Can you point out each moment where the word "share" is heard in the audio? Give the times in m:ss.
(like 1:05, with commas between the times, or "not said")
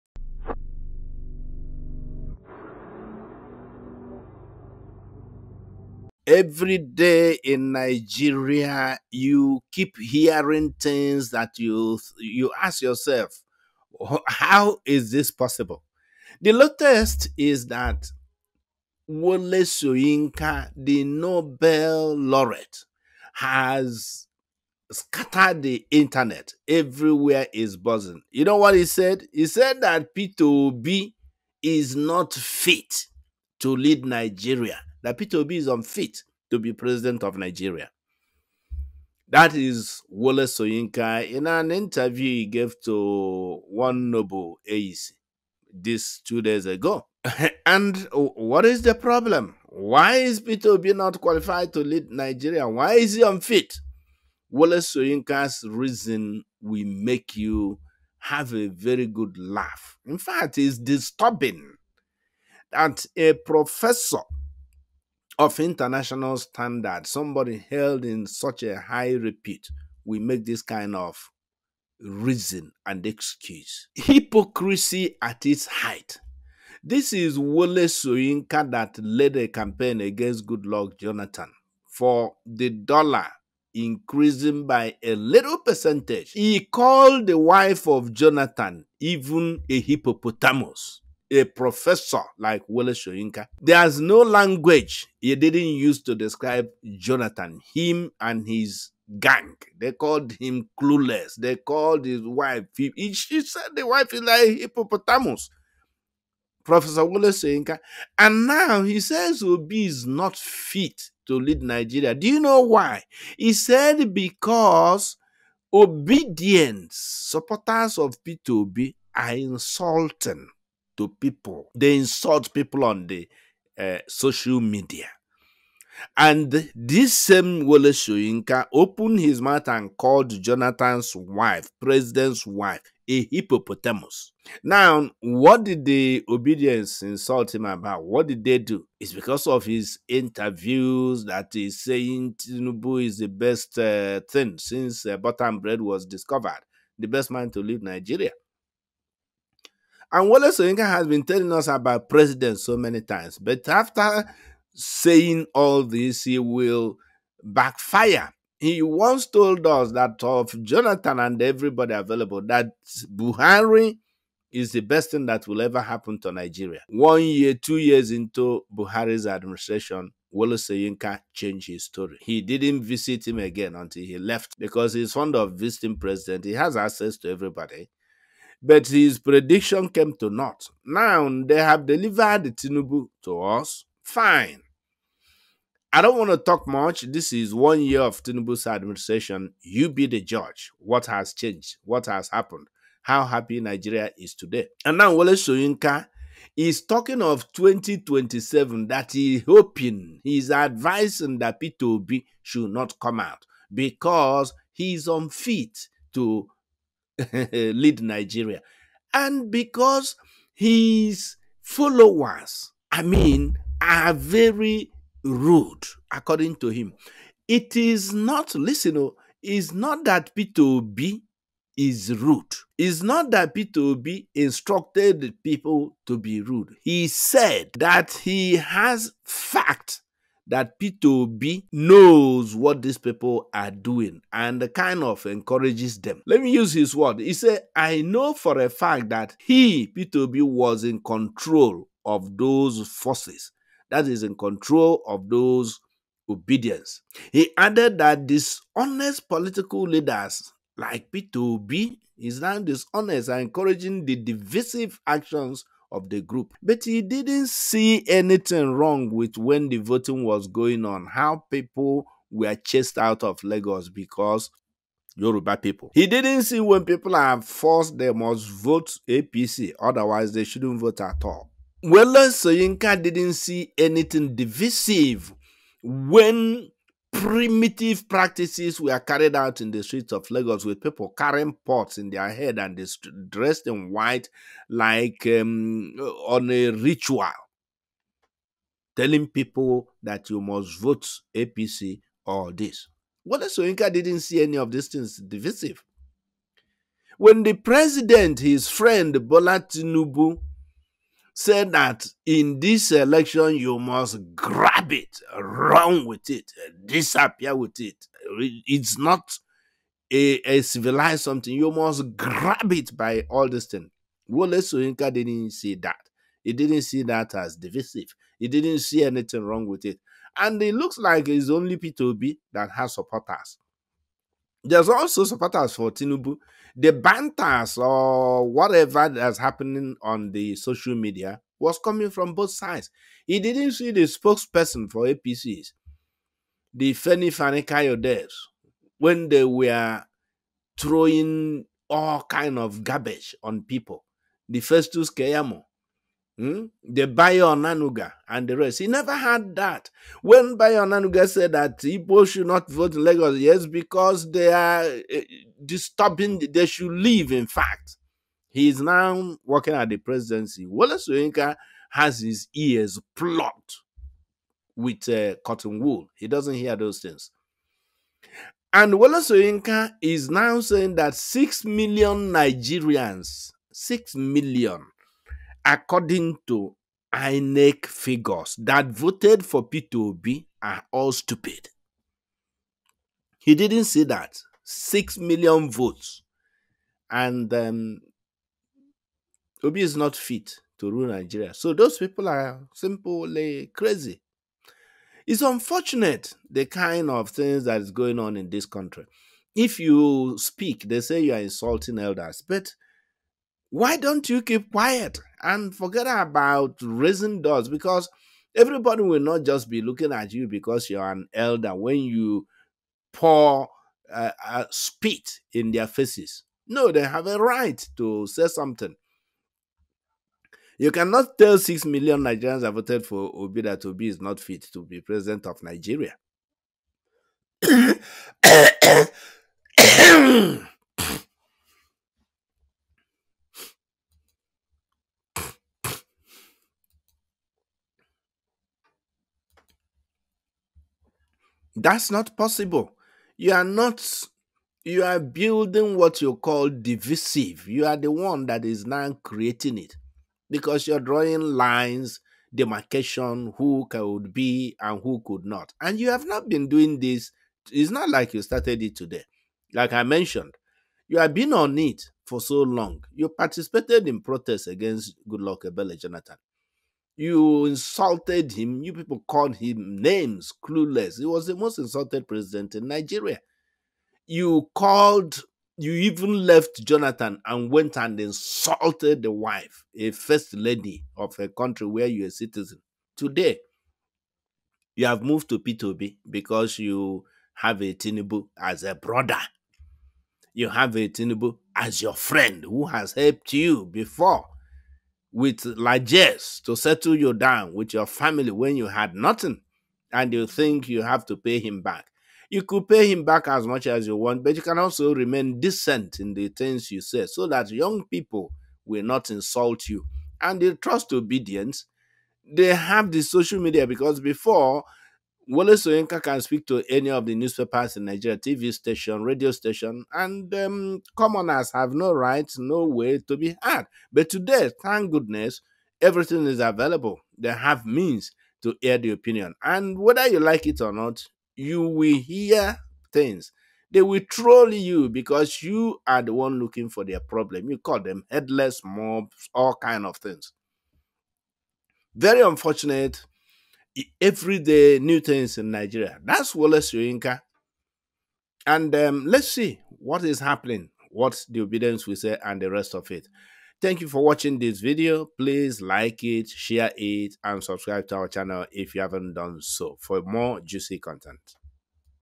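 9:16.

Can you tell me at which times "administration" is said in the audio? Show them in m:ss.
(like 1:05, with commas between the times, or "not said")
2:49, 3:08.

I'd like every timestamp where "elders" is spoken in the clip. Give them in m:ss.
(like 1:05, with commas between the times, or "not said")
6:41, 6:51.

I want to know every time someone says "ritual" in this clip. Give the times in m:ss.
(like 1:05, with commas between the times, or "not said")
4:46.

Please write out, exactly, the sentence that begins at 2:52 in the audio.
He didn't visit him again until he left because he's fond of visiting president.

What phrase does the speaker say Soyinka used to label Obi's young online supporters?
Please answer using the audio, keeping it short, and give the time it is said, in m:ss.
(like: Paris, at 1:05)
Headless mobs, at 8:58.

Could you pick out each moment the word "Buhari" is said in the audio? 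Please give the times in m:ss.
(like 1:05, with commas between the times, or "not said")
2:43, 2:48.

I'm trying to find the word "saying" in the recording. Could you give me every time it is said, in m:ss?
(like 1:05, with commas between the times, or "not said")
2:21, 2:34, 6:10.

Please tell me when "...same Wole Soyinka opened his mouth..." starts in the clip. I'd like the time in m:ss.
2:07.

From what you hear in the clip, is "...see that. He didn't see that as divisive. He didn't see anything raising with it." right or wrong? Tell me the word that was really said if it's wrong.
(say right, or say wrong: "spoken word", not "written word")
wrong: "wrong", not "raising".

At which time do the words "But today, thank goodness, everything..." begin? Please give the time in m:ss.
8:44.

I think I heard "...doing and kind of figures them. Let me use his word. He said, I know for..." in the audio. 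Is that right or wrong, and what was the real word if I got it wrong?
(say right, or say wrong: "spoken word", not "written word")
wrong: "encourages", not "figures".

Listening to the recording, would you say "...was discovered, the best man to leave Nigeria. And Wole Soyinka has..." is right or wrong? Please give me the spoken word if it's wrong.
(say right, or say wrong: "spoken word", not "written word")
right.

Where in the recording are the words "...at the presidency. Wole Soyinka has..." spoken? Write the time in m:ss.
5:59.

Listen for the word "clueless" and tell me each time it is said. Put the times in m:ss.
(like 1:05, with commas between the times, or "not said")
1:40, 7:50.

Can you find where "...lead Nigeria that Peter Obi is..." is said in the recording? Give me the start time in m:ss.
0:33.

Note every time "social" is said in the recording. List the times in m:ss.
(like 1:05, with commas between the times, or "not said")
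2:04, 5:30, 8:33.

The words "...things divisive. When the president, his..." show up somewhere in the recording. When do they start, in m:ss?
4:54.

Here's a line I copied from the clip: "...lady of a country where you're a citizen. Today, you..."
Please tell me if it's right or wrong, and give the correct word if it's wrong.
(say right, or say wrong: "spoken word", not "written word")
right.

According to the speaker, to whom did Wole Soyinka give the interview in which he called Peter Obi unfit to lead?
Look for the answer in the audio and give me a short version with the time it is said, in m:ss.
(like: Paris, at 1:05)
Noble AEC, at 0:44.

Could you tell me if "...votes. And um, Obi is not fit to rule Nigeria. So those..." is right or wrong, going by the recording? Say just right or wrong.
right.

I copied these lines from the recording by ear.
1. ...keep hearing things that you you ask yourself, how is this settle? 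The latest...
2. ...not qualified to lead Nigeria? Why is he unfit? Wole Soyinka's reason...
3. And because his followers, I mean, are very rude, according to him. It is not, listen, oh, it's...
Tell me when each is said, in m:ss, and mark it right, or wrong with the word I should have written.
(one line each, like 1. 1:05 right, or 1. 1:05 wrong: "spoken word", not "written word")
1. 0:09 wrong: "possible", not "settle"
2. 0:50 right
3. 3:29 right.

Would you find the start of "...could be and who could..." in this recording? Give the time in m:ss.
7:33.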